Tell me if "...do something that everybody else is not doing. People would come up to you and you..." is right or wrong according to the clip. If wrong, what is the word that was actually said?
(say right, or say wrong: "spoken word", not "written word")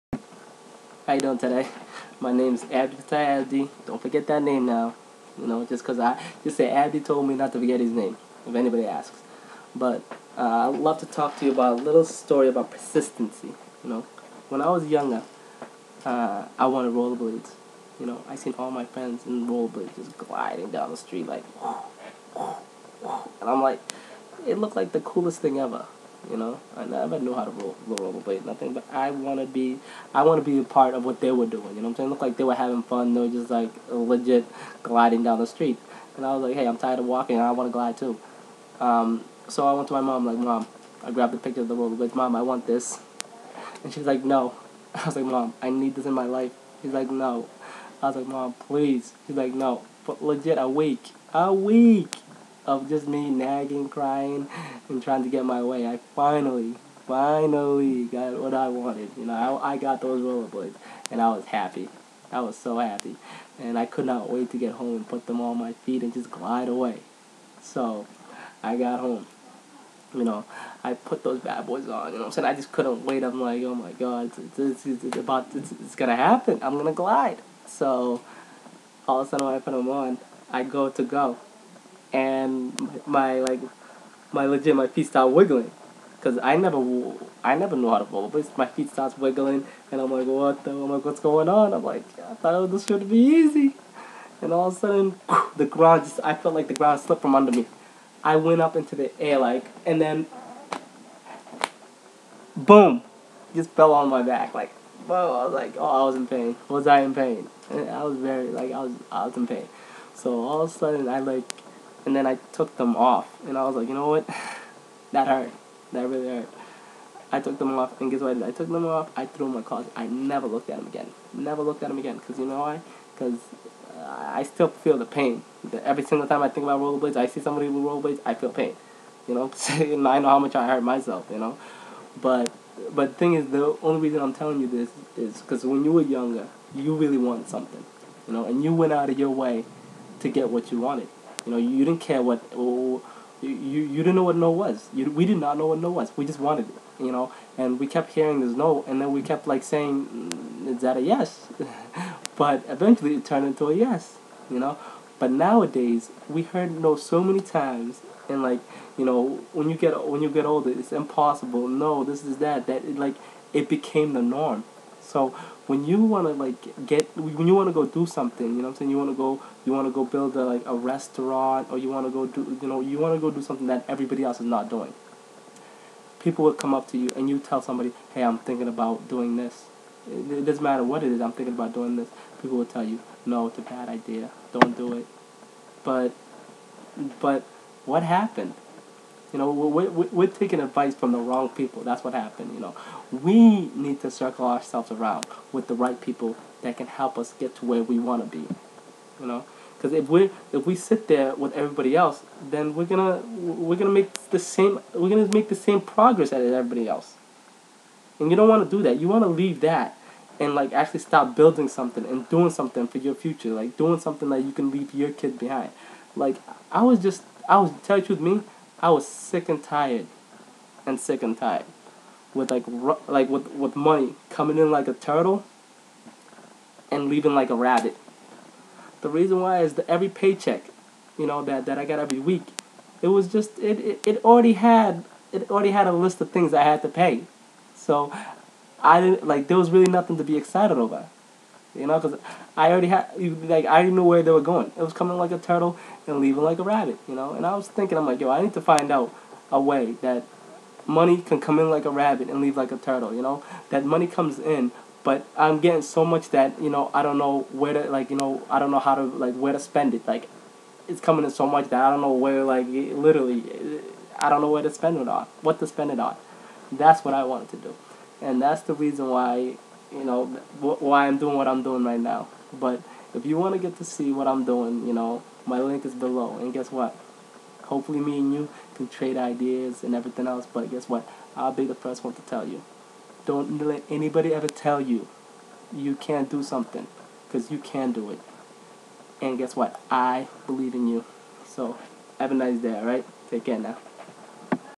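right.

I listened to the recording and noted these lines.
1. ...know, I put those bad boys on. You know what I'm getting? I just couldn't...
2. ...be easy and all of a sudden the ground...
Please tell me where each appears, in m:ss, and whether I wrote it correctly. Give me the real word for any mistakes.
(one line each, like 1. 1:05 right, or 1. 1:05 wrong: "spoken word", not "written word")
1. 1:10 wrong: "saying", not "getting"
2. 1:33 right.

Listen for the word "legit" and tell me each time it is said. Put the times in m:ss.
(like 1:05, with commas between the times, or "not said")
0:33, 0:50, 1:24.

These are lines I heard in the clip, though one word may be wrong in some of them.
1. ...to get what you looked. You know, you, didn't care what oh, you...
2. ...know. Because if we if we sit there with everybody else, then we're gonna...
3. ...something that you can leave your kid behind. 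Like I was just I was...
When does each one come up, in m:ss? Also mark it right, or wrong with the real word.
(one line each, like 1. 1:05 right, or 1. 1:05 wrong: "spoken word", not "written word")
1. 2:20 wrong: "wanted", not "looked"
2. 3:19 right
3. 3:33 right.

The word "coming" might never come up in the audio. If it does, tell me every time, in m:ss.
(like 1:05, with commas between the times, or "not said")
3:44, 4:04, 4:20.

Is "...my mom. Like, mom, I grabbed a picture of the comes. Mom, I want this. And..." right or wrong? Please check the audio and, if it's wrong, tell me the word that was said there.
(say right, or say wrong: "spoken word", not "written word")
wrong: "rollerblades", not "comes".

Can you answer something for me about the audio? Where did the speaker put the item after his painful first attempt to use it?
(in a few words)
In the closet.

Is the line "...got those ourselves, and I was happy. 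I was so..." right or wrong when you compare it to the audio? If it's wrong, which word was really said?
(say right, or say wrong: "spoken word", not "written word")
wrong: "rollerblades", not "ourselves".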